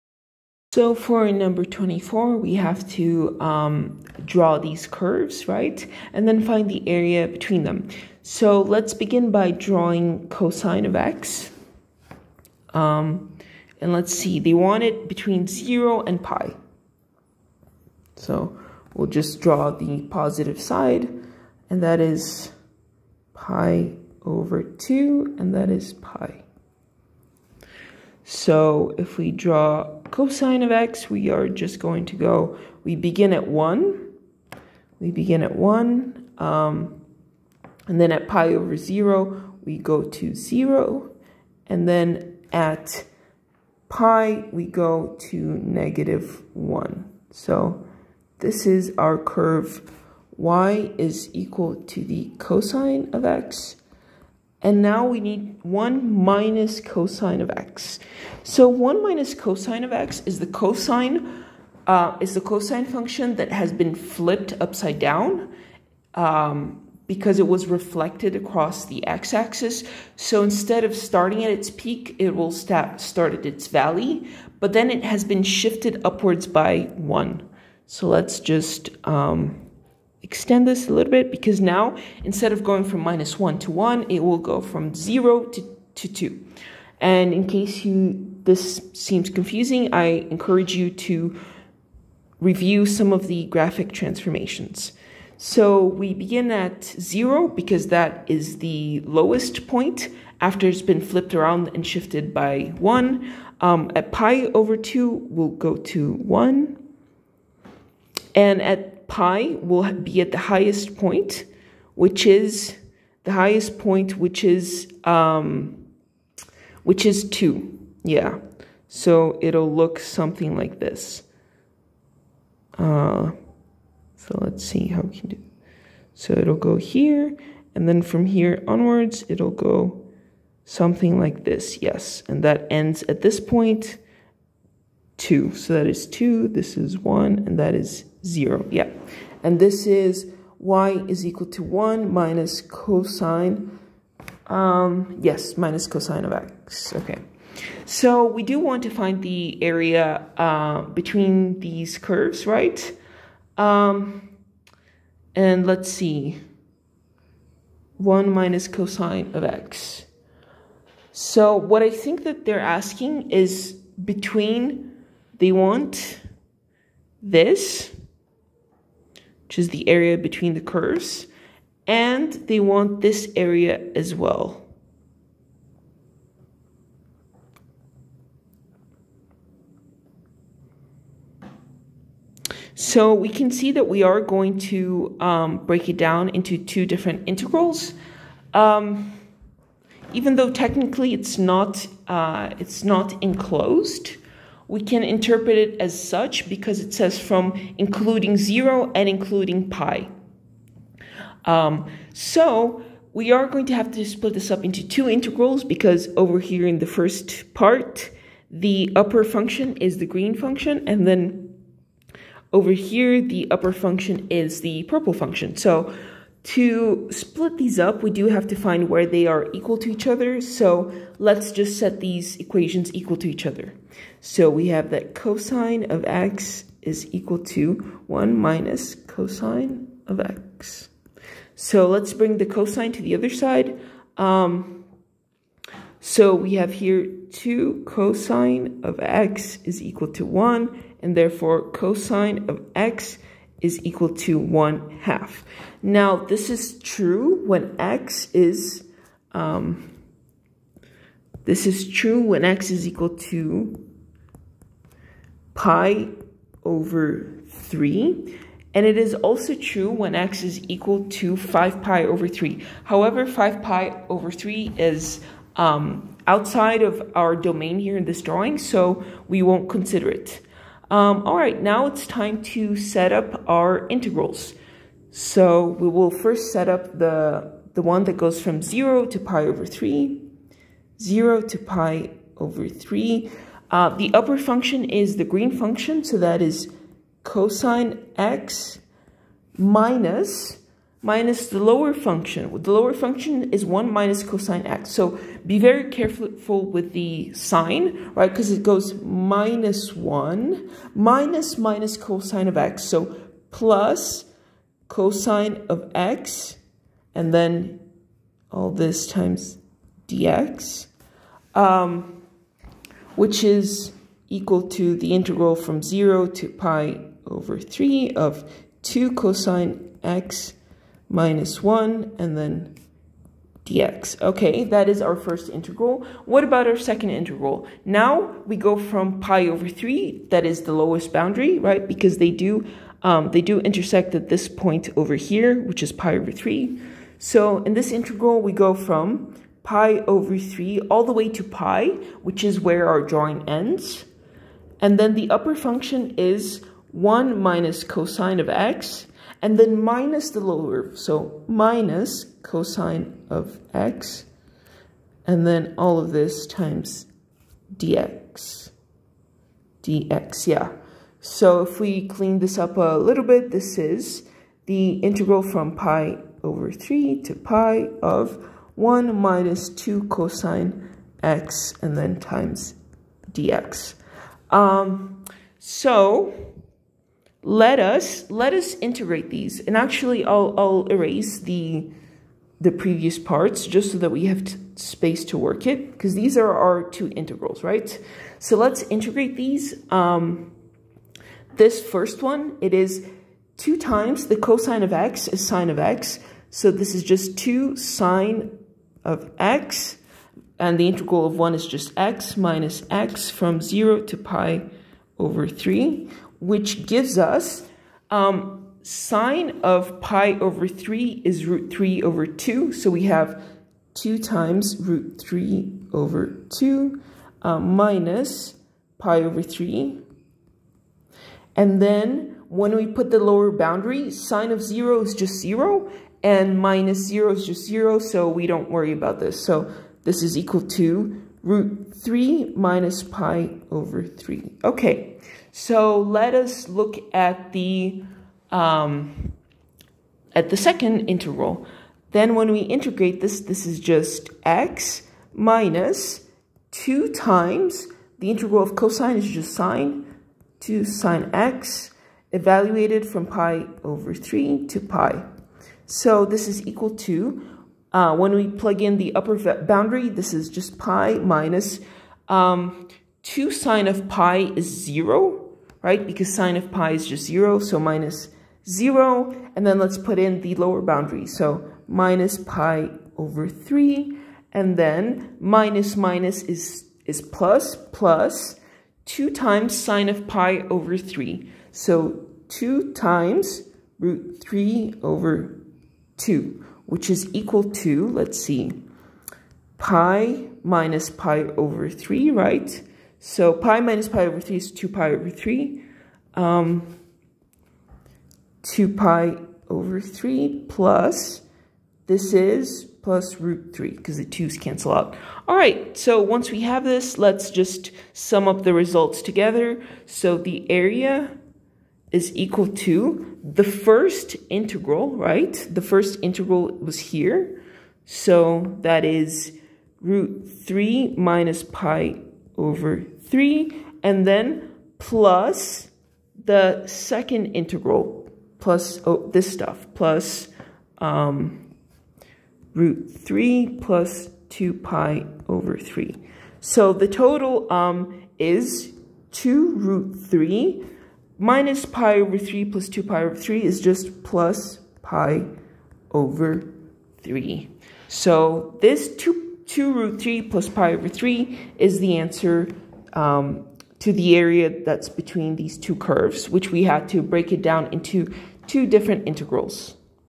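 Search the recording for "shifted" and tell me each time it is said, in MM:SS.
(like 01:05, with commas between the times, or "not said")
01:15, 01:41.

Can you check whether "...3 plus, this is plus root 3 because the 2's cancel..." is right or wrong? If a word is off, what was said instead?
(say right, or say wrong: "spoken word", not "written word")
right.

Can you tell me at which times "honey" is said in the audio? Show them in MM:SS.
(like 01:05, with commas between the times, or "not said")
not said.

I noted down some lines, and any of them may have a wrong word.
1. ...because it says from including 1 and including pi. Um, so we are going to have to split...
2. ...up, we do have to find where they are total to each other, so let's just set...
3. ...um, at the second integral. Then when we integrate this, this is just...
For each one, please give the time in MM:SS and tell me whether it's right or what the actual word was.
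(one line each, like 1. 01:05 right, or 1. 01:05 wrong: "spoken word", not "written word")
1. 03:16 wrong: "0", not "1"
2. 03:37 wrong: "equal", not "total"
3. 07:18 right.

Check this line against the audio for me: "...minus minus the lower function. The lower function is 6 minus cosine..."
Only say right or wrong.
wrong.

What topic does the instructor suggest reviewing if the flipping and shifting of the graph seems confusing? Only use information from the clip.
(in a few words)
graphic transformations.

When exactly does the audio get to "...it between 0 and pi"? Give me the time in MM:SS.
00:14.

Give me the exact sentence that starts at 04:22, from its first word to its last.
However, 5 pi over 3 is um, outside of our domain here in this drawing, so we won't consider it.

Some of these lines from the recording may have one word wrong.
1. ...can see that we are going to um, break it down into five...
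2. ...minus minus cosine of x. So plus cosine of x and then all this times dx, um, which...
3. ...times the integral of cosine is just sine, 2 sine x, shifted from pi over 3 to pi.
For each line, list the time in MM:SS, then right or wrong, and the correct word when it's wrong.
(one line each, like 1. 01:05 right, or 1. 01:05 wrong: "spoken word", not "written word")
1. 03:03 wrong: "two", not "five"
2. 05:00 right
3. 07:27 wrong: "evaluated", not "shifted".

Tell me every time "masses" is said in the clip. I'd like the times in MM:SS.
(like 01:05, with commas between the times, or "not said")
not said.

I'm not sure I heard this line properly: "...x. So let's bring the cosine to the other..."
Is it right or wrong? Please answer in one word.
right.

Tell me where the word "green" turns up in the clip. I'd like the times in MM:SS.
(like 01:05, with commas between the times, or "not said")
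03:30, 04:45.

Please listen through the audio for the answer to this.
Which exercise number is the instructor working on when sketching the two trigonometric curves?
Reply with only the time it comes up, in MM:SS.
00:01.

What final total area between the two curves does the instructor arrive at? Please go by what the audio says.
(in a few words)
2 root 3 + pi/3.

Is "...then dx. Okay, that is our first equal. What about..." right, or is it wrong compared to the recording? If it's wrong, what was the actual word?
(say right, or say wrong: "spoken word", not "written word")
wrong: "integral", not "equal".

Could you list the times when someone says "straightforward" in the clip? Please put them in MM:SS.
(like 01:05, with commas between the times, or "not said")
not said.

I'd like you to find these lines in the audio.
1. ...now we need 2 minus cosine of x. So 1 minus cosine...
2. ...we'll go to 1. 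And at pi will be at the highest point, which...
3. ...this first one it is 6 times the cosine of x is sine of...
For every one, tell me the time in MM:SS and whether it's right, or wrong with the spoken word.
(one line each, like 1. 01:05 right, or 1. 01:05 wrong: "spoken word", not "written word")
1. 00:54 wrong: "1", not "2"
2. 01:45 right
3. 06:31 wrong: "2", not "6".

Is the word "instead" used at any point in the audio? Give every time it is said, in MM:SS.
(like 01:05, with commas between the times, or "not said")
01:10, 01:22.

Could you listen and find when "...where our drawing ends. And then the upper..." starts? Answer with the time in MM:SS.
05:42.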